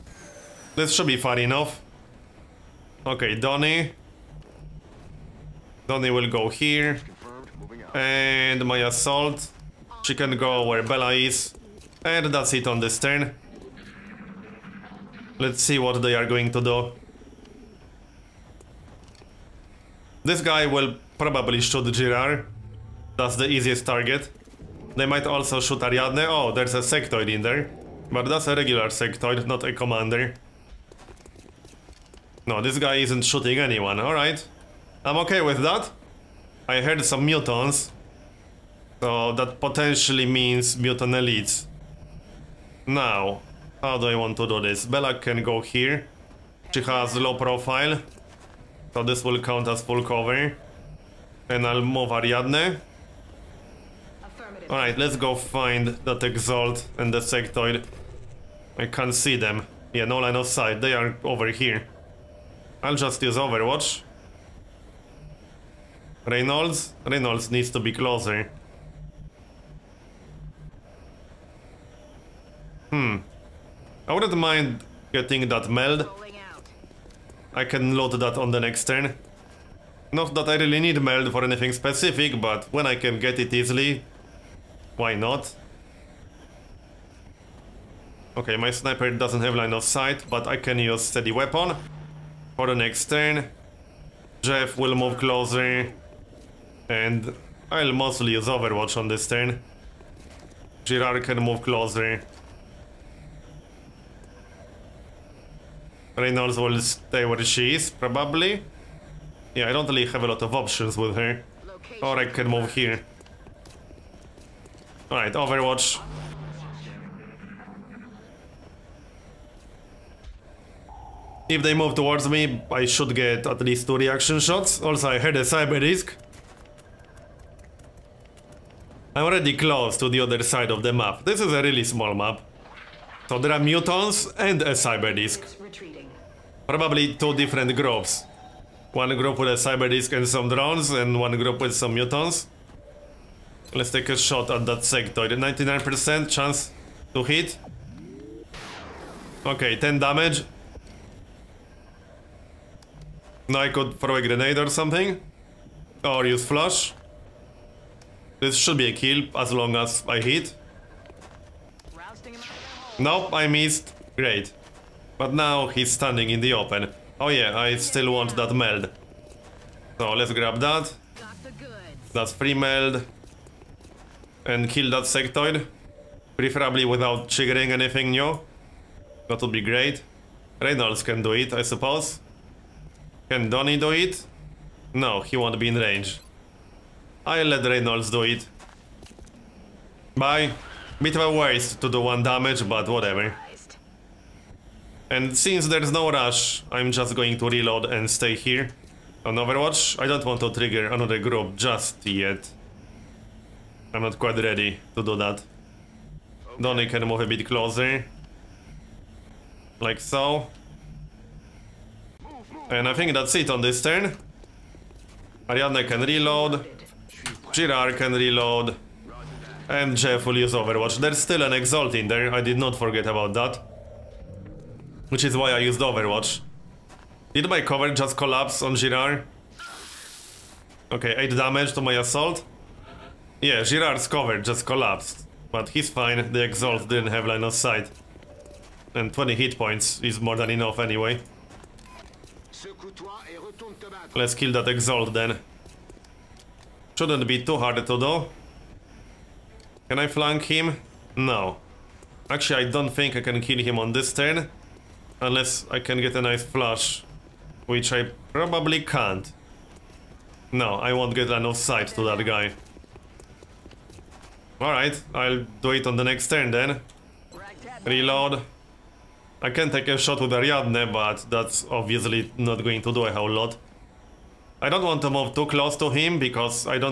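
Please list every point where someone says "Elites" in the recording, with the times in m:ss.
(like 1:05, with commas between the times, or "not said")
0:41.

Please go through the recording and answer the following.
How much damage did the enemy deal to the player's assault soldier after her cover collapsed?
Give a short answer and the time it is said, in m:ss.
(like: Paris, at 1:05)
8, at 3:51.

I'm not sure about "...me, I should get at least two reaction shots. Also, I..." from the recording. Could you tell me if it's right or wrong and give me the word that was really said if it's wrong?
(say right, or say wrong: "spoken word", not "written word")
right.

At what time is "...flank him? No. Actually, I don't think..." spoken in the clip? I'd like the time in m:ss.
4:10.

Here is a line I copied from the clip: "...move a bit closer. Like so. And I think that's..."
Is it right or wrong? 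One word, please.
right.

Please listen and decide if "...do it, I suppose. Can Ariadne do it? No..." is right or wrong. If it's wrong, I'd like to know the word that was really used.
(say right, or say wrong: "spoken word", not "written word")
wrong: "Donny", not "Ariadne".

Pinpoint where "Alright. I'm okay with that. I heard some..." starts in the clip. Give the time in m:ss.
0:33.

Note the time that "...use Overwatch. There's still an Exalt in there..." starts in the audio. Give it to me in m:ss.
3:40.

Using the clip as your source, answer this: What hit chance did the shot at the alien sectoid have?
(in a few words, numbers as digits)
99%.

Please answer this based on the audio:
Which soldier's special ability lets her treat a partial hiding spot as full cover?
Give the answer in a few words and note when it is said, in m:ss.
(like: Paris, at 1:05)
Low profile, at 0:47.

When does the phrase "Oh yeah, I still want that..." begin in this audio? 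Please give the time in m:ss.
2:47.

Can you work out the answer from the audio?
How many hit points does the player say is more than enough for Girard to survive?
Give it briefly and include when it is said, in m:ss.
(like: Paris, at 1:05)
20, at 3:59.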